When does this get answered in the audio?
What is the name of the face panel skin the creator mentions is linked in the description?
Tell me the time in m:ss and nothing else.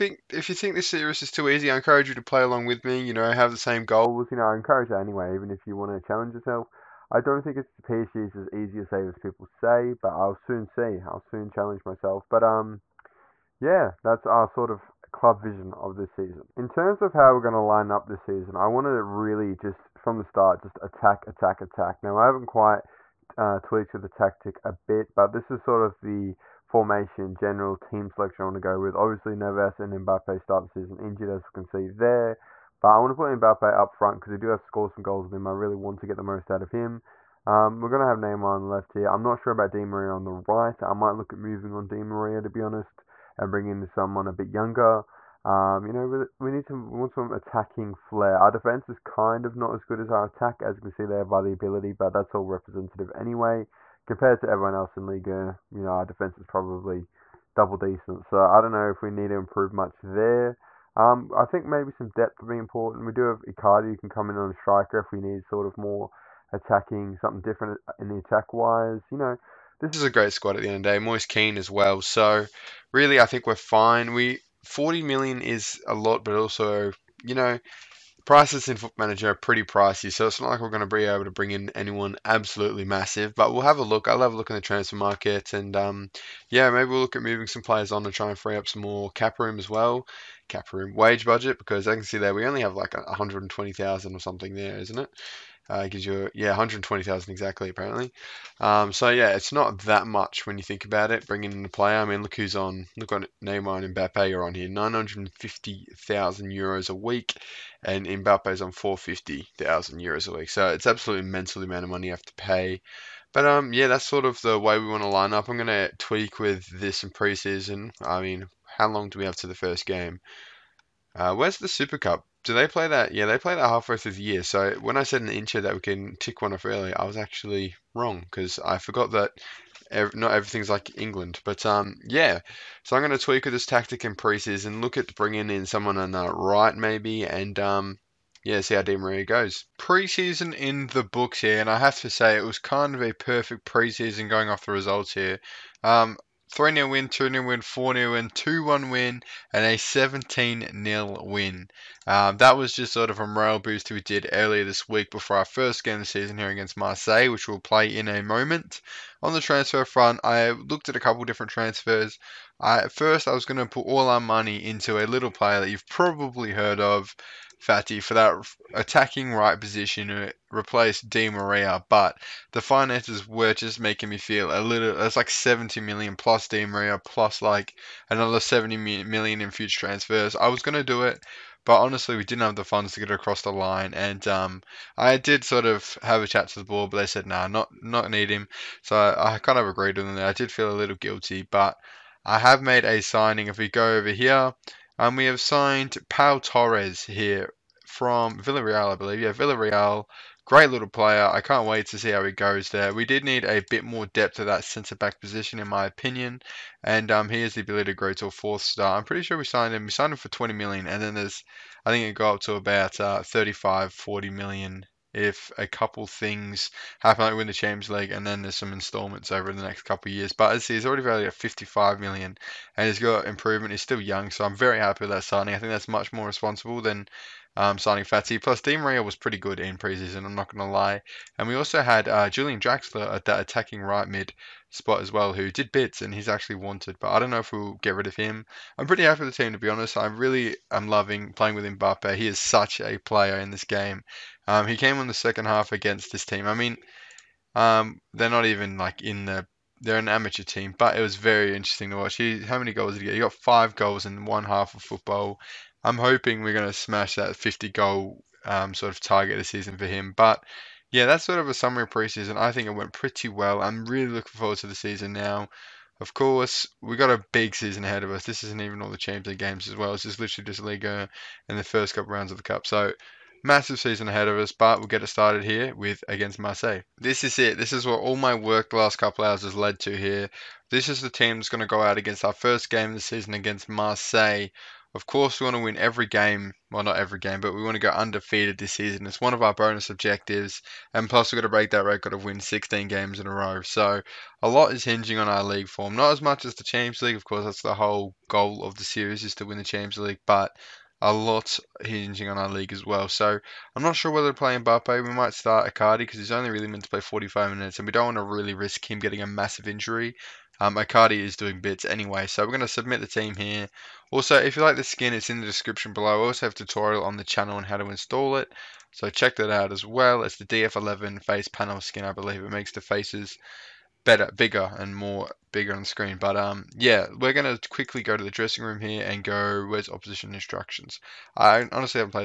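5:20.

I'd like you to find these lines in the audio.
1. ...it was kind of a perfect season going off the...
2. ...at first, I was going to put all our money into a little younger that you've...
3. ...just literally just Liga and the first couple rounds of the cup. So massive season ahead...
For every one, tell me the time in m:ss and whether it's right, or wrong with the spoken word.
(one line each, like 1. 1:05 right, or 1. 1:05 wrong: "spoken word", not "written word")
1. 2:22 wrong: "preseason", not "season"
2. 2:42 wrong: "player", not "younger"
3. 4:30 right.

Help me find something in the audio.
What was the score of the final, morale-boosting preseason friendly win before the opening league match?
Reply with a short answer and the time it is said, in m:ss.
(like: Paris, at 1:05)
17-0, at 2:29.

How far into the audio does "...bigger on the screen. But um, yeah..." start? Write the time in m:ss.
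5:25.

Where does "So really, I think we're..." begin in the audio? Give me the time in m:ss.
1:12.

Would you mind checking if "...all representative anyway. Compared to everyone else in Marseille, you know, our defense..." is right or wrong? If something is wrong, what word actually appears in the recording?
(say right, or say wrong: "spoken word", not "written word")
wrong: "Liga", not "Marseille".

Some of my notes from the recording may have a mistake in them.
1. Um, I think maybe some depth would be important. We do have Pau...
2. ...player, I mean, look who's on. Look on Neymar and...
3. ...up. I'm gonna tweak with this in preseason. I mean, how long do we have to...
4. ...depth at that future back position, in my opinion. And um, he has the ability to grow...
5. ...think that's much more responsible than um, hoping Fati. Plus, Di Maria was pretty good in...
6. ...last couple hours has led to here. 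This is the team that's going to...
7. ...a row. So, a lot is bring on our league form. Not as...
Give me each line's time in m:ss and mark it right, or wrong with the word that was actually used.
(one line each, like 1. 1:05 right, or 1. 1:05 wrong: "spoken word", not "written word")
1. 1:00 wrong: "Icardi", not "Pau"
2. 1:41 right
3. 1:55 right
4. 3:24 wrong: "centre", not "future"
5. 3:45 wrong: "signing", not "hoping"
6. 4:38 right
7. 4:53 wrong: "hinging", not "bring".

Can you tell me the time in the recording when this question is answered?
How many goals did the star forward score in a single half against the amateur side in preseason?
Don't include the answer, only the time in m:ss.
4:13.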